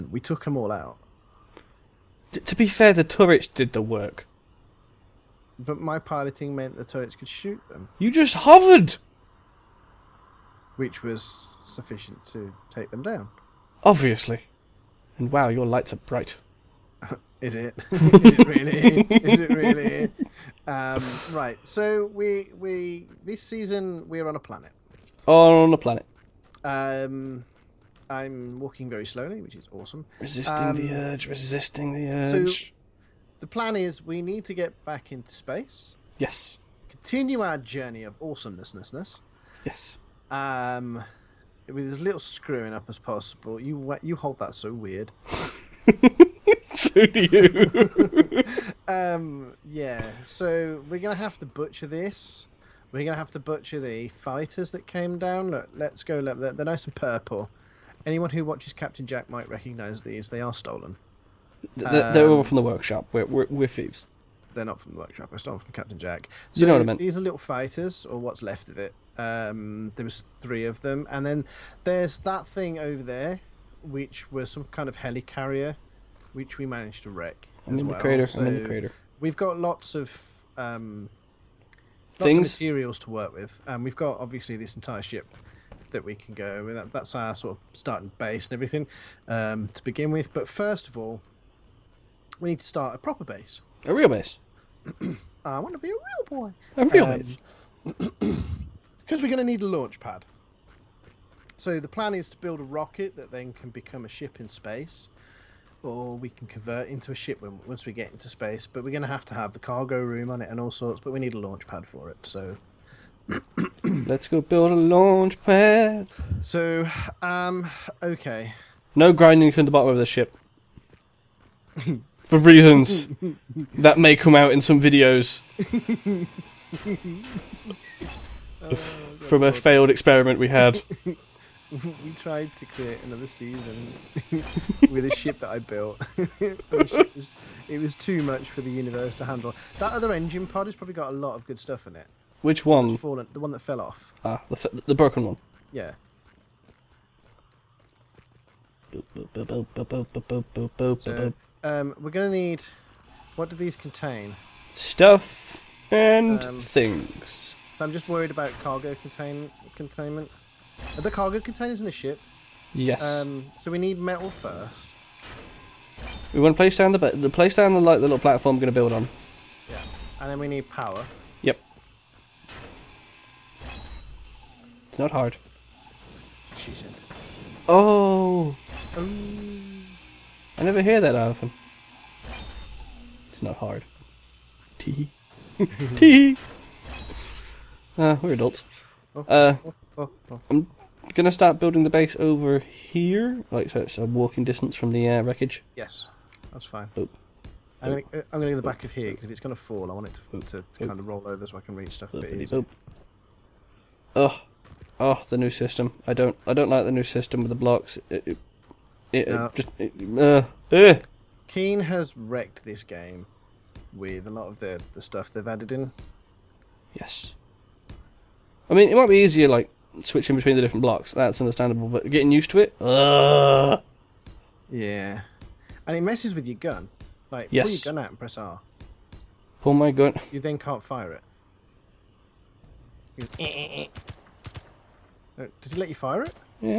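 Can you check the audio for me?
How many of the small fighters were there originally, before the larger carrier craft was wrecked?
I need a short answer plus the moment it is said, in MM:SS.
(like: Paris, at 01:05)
3, at 01:10.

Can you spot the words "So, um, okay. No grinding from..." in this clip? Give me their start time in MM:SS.
01:56.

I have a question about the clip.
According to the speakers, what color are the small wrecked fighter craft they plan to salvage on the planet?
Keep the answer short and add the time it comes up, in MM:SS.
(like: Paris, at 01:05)
purple, at 00:56.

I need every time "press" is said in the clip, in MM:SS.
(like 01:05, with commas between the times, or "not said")
03:48.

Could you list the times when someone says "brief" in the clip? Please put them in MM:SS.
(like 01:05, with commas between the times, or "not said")
not said.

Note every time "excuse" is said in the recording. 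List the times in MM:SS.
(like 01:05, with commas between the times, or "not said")
not said.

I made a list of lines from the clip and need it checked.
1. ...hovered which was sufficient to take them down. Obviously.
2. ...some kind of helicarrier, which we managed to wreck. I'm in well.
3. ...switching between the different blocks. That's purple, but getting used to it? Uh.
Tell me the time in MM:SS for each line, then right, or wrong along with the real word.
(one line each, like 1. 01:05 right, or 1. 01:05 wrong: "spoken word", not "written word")
1. 00:08 right
2. 01:14 right
3. 03:40 wrong: "understandable", not "purple".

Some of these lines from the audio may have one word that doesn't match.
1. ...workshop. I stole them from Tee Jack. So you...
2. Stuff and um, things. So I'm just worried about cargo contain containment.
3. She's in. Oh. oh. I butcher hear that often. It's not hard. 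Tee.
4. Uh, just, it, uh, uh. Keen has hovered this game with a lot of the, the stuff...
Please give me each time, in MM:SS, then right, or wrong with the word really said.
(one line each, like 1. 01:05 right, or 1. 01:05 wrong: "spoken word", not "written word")
1. 01:04 wrong: "Captain", not "Tee"
2. 02:34 right
3. 02:56 wrong: "never", not "butcher"
4. 03:29 wrong: "wrecked", not "hovered".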